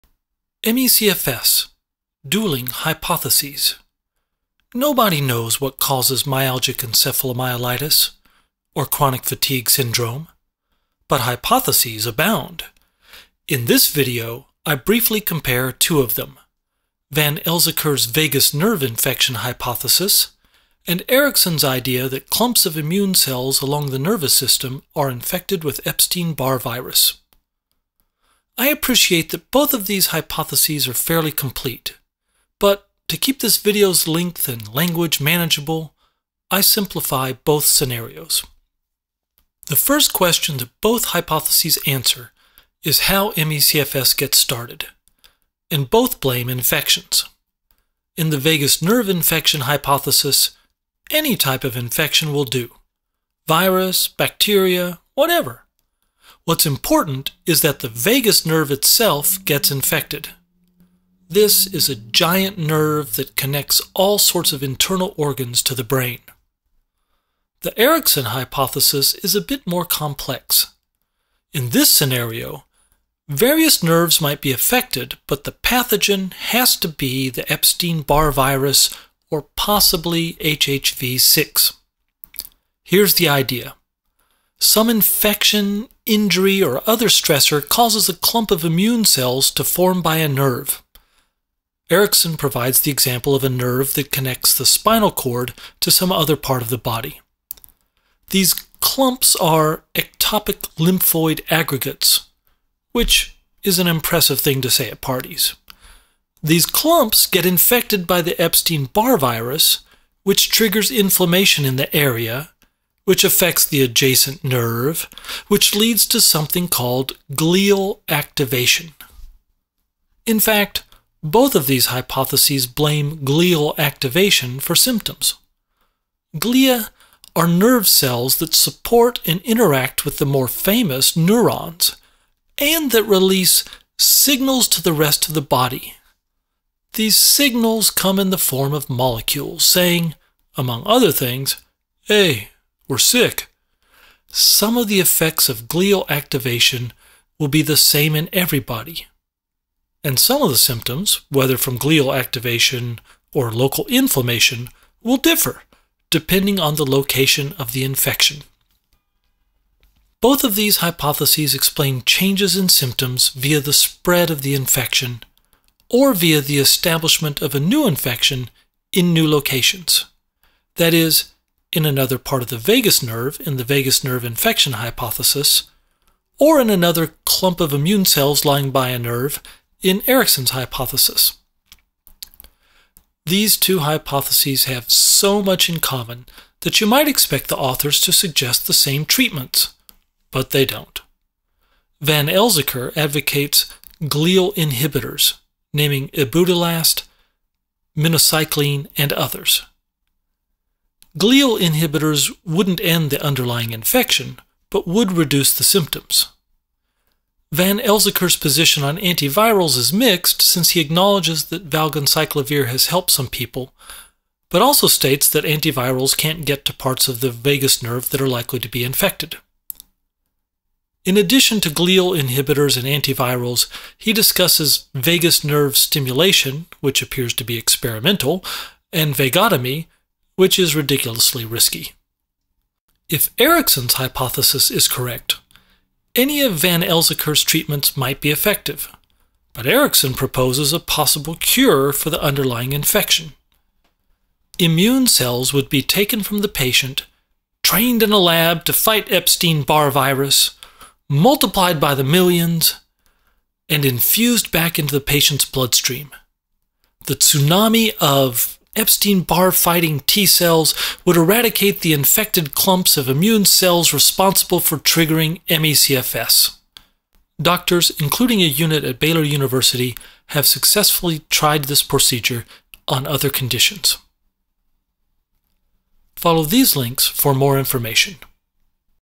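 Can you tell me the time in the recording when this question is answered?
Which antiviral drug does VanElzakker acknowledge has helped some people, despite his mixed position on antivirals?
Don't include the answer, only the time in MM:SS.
03:31.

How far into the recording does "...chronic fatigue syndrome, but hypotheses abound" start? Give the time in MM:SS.
00:08.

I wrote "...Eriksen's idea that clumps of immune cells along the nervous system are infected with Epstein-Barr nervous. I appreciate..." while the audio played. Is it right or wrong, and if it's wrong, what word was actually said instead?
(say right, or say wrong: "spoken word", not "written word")
wrong: "virus", not "nervous".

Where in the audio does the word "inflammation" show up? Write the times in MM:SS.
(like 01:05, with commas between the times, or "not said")
01:50, 02:33.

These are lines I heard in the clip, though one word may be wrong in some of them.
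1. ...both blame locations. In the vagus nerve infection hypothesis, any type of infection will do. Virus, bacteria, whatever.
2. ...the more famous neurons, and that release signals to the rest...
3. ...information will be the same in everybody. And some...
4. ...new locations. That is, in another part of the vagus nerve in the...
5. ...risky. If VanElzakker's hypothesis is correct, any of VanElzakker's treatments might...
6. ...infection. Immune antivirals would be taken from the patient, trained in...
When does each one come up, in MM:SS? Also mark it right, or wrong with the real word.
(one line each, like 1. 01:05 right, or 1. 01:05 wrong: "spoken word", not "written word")
1. 00:45 wrong: "infections", not "locations"
2. 02:10 right
3. 02:26 wrong: "activation", not "information"
4. 02:49 right
5. 03:51 wrong: "Eriksen", not "VanElzakker"
6. 04:02 wrong: "cells", not "antivirals".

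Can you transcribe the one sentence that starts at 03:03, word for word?
These two hypotheses have so much in common that you might expect the authors to suggest the same treatments, but they don't.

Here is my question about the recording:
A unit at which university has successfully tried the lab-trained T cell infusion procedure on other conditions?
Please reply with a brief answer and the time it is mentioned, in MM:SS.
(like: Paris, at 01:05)
Baylor University, at 04:28.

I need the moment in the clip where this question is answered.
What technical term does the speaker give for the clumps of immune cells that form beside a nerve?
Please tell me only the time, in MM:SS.
01:39.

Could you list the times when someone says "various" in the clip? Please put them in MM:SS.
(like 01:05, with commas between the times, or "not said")
01:13.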